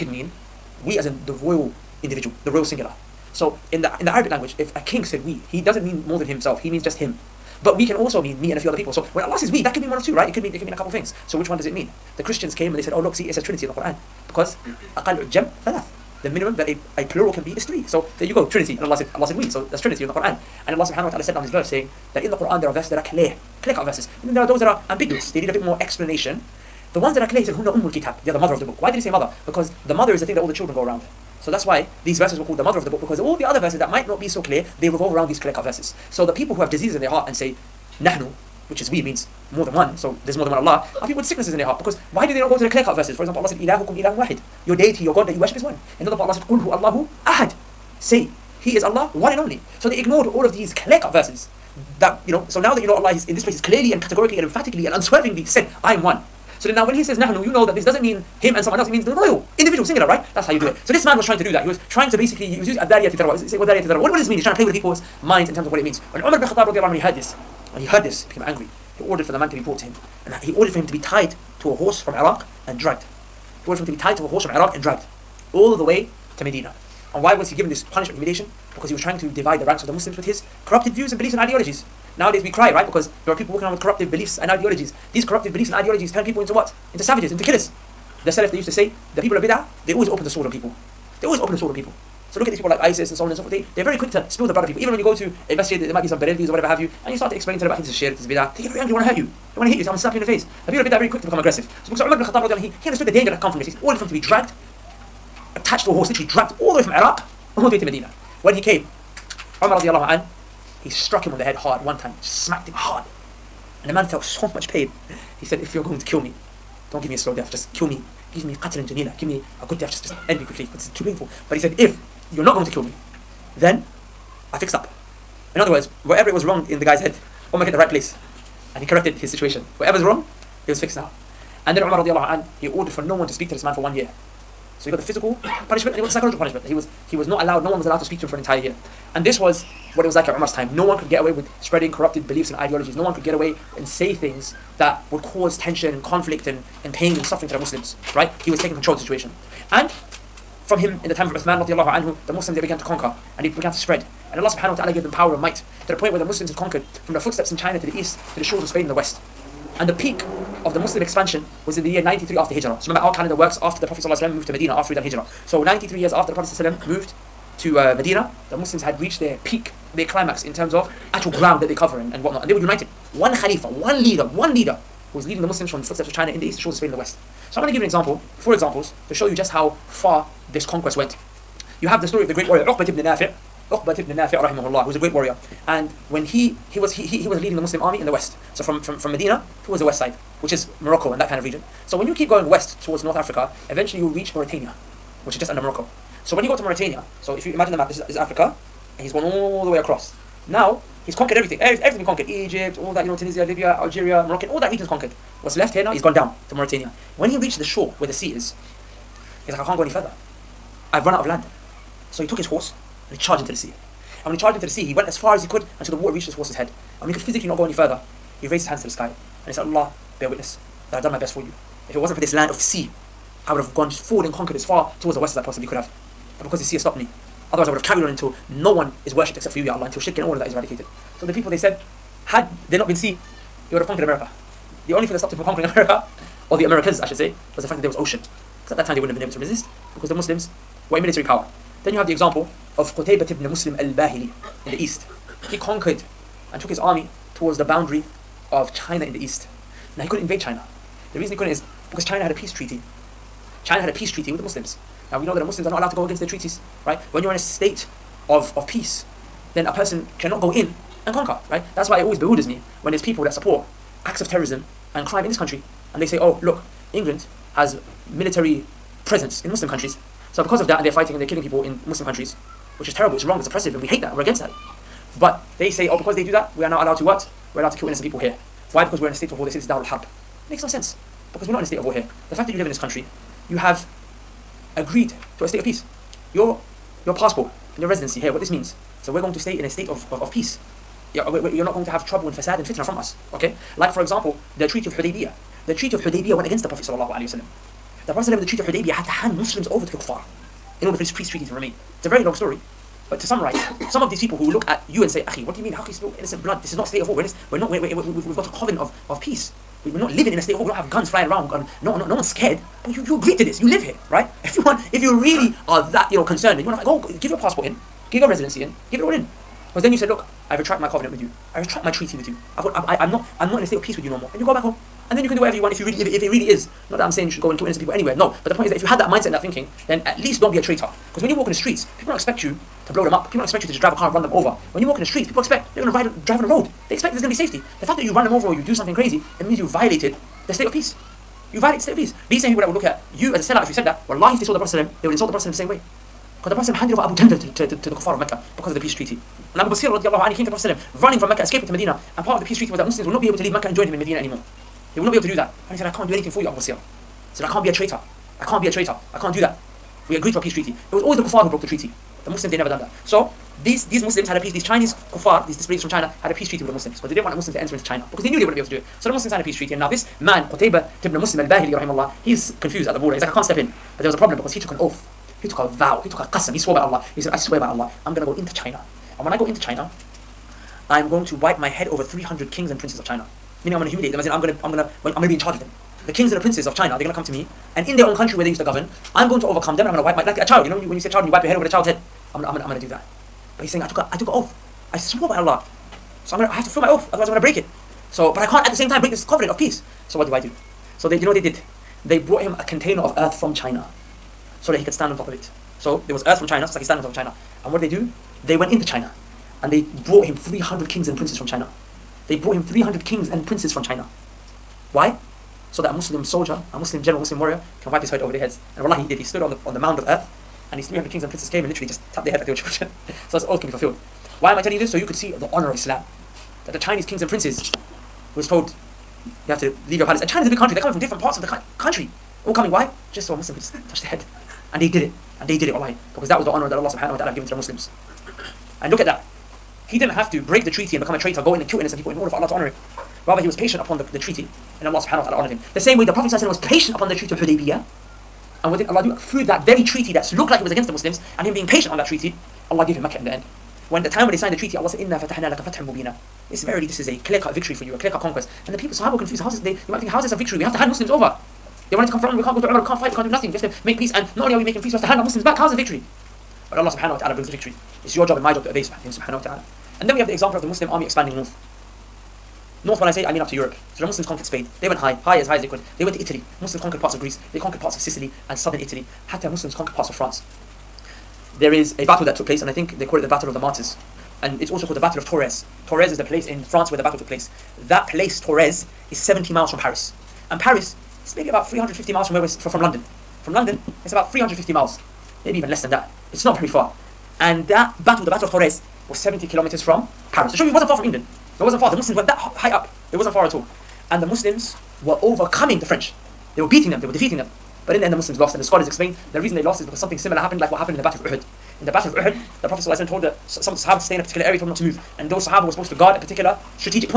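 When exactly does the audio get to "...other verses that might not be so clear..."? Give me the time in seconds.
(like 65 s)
33 s.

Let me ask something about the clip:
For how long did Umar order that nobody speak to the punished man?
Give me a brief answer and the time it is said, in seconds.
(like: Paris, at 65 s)
1 year, at 133 s.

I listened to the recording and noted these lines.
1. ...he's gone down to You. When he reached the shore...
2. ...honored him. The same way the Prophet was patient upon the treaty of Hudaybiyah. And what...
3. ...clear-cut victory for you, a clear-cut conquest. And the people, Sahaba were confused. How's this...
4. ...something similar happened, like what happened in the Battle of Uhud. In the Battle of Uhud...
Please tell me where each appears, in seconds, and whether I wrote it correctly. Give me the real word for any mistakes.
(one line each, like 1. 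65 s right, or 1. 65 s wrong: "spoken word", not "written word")
1. 205 s wrong: "Mauritania", not "You"
2. 445 s right
3. 457 s right
4. 509 s right.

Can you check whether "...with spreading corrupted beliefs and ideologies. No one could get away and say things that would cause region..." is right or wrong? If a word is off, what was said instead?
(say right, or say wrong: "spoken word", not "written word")
wrong: "tension", not "region".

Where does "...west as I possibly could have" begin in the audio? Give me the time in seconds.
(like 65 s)
225 s.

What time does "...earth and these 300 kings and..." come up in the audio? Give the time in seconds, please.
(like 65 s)
420 s.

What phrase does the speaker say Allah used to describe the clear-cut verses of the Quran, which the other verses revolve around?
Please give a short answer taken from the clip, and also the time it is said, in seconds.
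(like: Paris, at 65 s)
Ummul Kitab, at 27 s.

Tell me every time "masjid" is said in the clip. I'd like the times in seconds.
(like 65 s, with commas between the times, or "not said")
95 s.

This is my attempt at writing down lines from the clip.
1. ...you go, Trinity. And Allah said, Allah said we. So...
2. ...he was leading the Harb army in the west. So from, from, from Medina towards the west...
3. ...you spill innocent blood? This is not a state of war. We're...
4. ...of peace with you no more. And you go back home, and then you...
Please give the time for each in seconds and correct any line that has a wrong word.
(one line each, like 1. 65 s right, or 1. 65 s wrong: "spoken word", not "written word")
1. 18 s right
2. 187 s wrong: "Muslim", not "Harb"
3. 305 s right
4. 323 s right.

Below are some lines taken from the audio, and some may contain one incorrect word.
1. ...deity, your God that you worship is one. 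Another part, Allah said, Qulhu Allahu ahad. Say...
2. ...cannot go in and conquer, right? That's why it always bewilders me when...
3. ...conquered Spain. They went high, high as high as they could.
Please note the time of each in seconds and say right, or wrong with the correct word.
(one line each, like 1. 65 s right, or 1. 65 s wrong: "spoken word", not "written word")
1. 44 s right
2. 260 s right
3. 474 s right.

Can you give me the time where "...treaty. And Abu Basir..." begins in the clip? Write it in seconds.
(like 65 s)
348 s.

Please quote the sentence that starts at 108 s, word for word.
When he came, Umar radiallahu an, he struck him on the head hard one time, smacked him hard.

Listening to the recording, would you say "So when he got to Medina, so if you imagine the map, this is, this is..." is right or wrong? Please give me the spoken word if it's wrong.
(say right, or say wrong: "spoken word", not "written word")
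wrong: "Mauritania", not "Medina".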